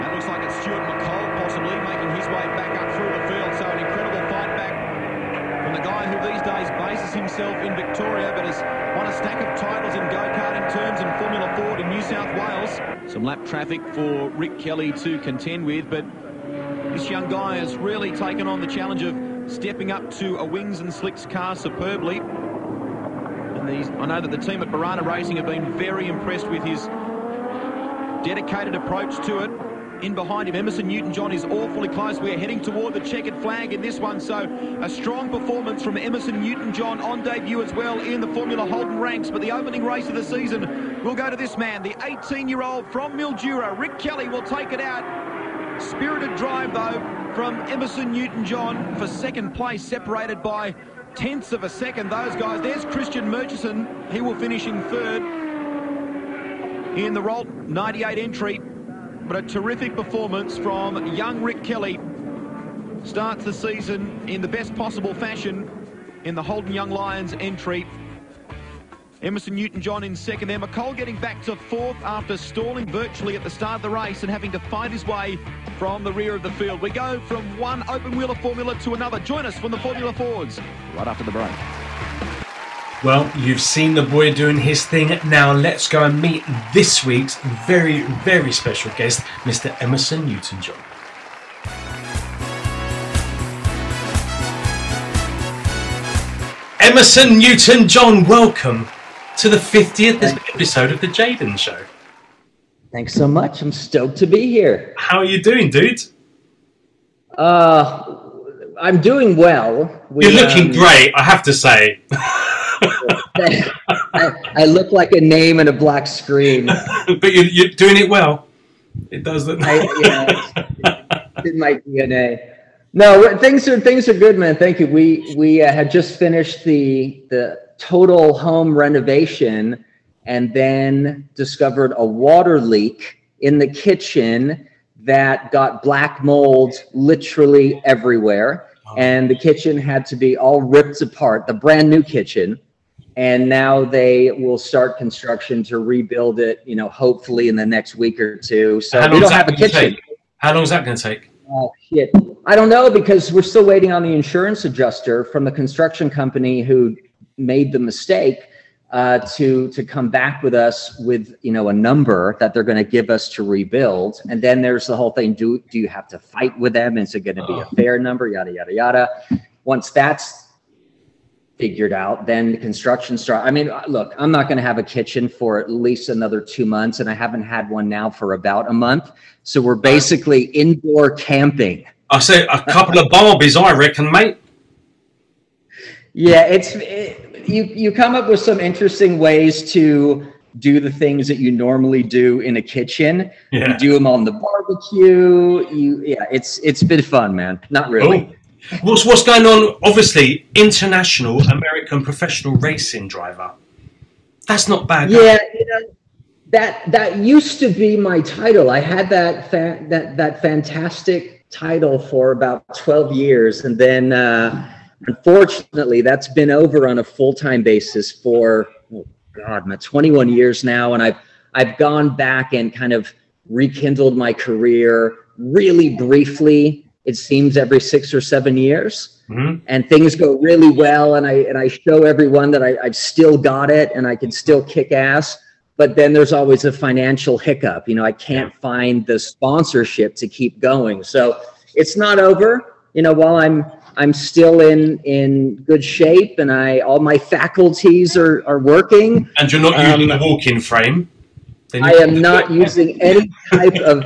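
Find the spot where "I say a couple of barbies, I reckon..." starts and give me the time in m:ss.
3:02.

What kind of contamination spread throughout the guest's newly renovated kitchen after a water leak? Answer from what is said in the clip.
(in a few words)
Black mold.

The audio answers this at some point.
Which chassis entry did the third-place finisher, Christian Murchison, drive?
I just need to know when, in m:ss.
0:57.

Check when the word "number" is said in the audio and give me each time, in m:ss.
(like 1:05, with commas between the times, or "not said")
2:41, 2:47.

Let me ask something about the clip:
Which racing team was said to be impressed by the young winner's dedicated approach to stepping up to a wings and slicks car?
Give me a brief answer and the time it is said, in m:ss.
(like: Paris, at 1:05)
Birrana Racing, at 0:24.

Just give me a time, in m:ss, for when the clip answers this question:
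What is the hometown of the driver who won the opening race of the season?
0:43.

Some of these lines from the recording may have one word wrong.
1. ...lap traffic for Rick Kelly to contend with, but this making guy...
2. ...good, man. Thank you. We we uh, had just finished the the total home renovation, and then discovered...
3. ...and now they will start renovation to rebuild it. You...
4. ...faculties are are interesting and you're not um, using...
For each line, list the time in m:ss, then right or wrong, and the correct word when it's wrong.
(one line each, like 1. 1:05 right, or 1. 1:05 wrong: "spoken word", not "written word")
1. 0:13 wrong: "young", not "making"
2. 2:04 right
3. 2:23 wrong: "construction", not "renovation"
4. 4:07 wrong: "working", not "interesting".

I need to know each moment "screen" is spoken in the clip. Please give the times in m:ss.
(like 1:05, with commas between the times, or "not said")
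1:56.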